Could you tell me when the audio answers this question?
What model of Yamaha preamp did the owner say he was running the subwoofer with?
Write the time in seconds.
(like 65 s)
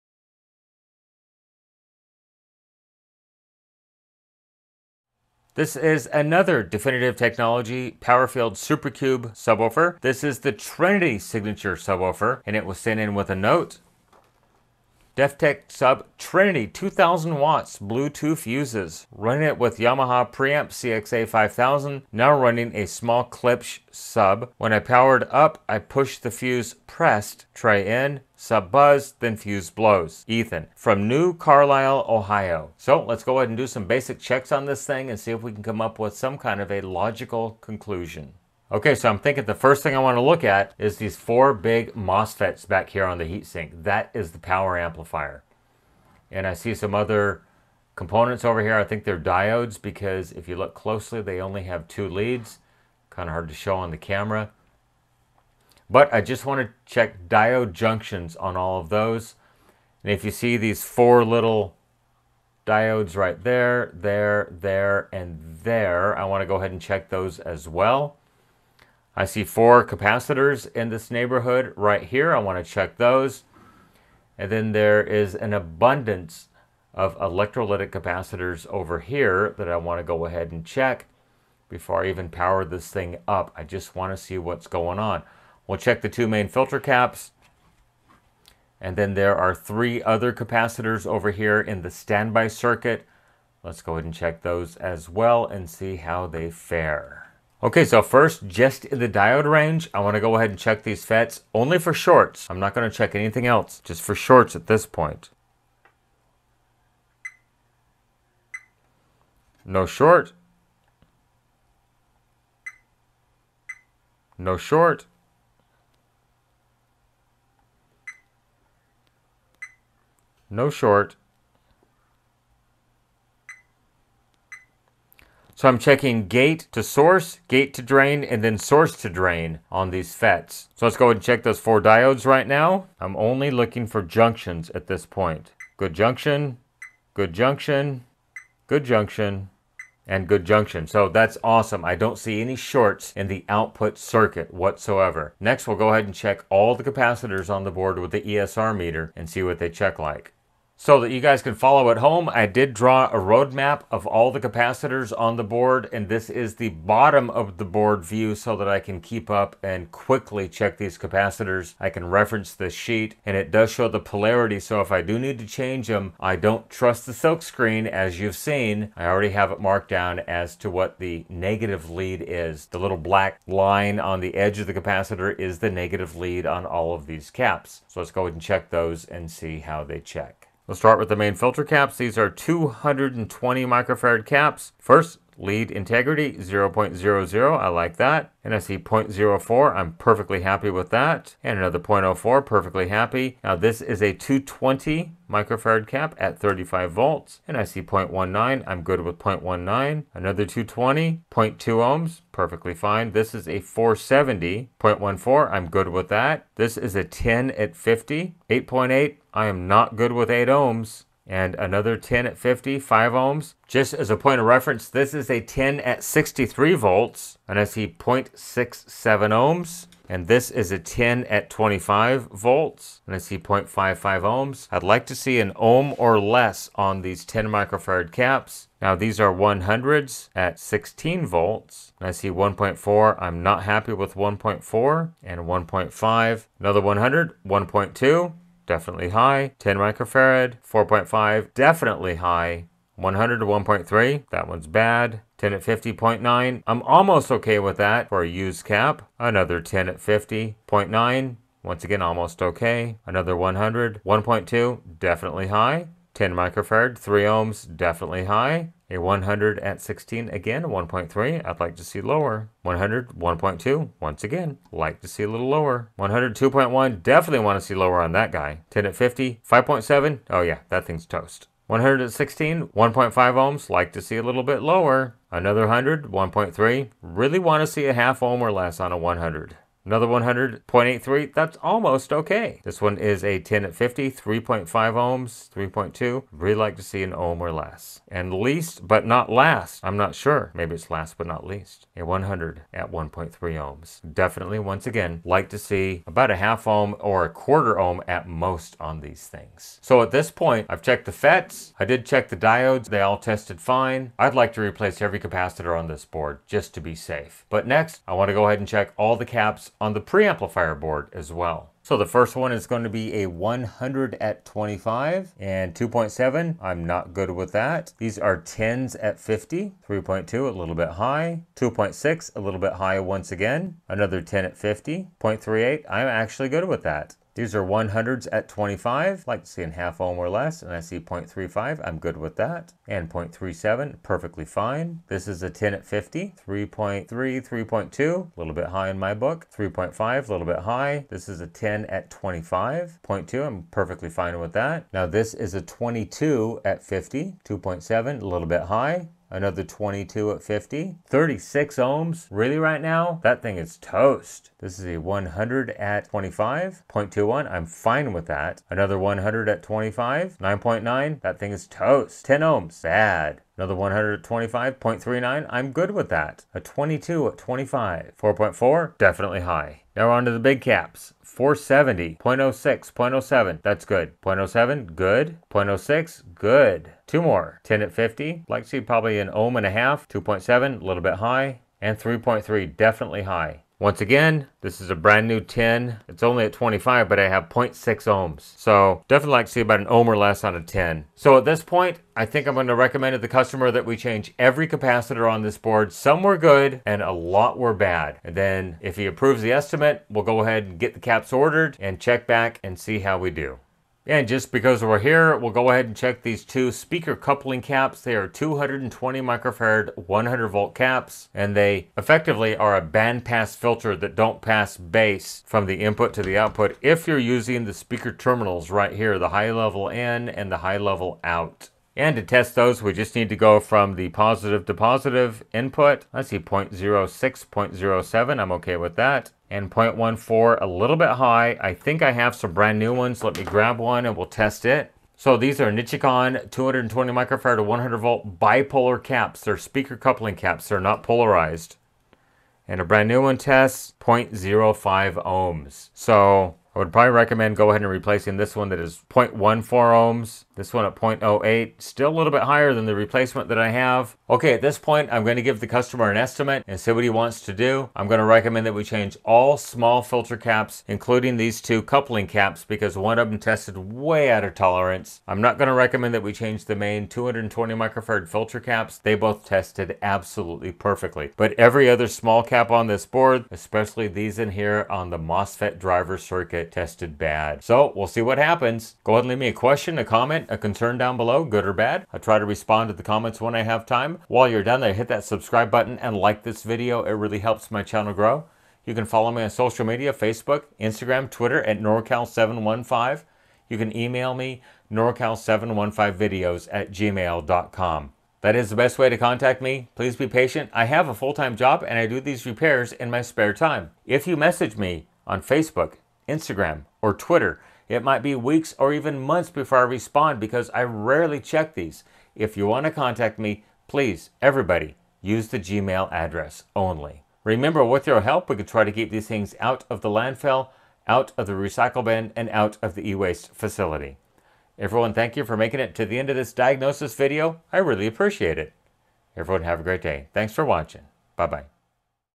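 20 s.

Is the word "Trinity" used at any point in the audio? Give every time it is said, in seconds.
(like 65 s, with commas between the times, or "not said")
10 s, 16 s.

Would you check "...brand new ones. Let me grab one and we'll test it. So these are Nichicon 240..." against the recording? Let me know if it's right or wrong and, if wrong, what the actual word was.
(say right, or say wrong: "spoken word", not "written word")
wrong: "220", not "240".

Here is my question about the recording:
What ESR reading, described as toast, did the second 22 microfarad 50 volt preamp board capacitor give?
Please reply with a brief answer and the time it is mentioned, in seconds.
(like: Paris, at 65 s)
36 ohms, at 351 s.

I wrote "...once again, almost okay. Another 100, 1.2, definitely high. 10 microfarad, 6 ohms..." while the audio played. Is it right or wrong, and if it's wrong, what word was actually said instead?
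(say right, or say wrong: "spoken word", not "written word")
wrong: "3", not "6".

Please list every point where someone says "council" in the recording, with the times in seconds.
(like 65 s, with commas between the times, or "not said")
not said.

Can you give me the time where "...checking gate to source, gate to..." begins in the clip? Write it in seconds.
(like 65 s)
125 s.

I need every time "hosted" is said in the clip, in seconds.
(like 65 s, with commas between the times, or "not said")
not said.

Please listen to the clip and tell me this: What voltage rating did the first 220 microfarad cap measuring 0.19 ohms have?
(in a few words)
35 volts.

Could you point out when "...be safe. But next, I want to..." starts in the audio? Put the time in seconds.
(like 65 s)
306 s.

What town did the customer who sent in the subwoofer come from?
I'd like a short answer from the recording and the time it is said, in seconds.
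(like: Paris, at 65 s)
New Carlisle, Ohio, at 31 s.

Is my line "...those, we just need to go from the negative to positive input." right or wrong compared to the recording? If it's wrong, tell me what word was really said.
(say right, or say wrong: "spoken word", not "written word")
wrong: "positive", not "negative".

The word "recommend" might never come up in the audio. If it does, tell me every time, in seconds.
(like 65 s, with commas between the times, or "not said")
392 s, 447 s, 458 s, 465 s.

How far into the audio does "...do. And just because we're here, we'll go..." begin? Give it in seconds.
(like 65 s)
403 s.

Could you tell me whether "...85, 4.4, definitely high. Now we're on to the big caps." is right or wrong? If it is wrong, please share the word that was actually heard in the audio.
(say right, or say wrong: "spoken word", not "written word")
wrong: "25", not "85".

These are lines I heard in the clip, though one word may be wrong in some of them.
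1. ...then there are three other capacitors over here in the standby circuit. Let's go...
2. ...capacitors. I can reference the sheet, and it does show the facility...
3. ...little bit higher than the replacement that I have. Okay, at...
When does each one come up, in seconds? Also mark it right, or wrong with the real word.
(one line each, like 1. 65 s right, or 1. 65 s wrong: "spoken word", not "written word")
1. 88 s right
2. 160 s wrong: "polarity", not "facility"
3. 452 s right.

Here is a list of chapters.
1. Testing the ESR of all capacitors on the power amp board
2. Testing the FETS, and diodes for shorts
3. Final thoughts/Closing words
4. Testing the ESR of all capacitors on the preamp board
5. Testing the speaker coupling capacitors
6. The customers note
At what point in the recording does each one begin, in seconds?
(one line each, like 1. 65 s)
1. 150 s
2. 38 s
3. 454 s
4. 312 s
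5. 403 s
6. 14 s.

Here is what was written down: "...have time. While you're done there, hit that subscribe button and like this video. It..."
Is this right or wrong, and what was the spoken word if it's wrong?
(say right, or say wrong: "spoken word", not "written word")
right.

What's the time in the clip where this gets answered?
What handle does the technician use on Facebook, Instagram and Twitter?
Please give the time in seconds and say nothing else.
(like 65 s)
491 s.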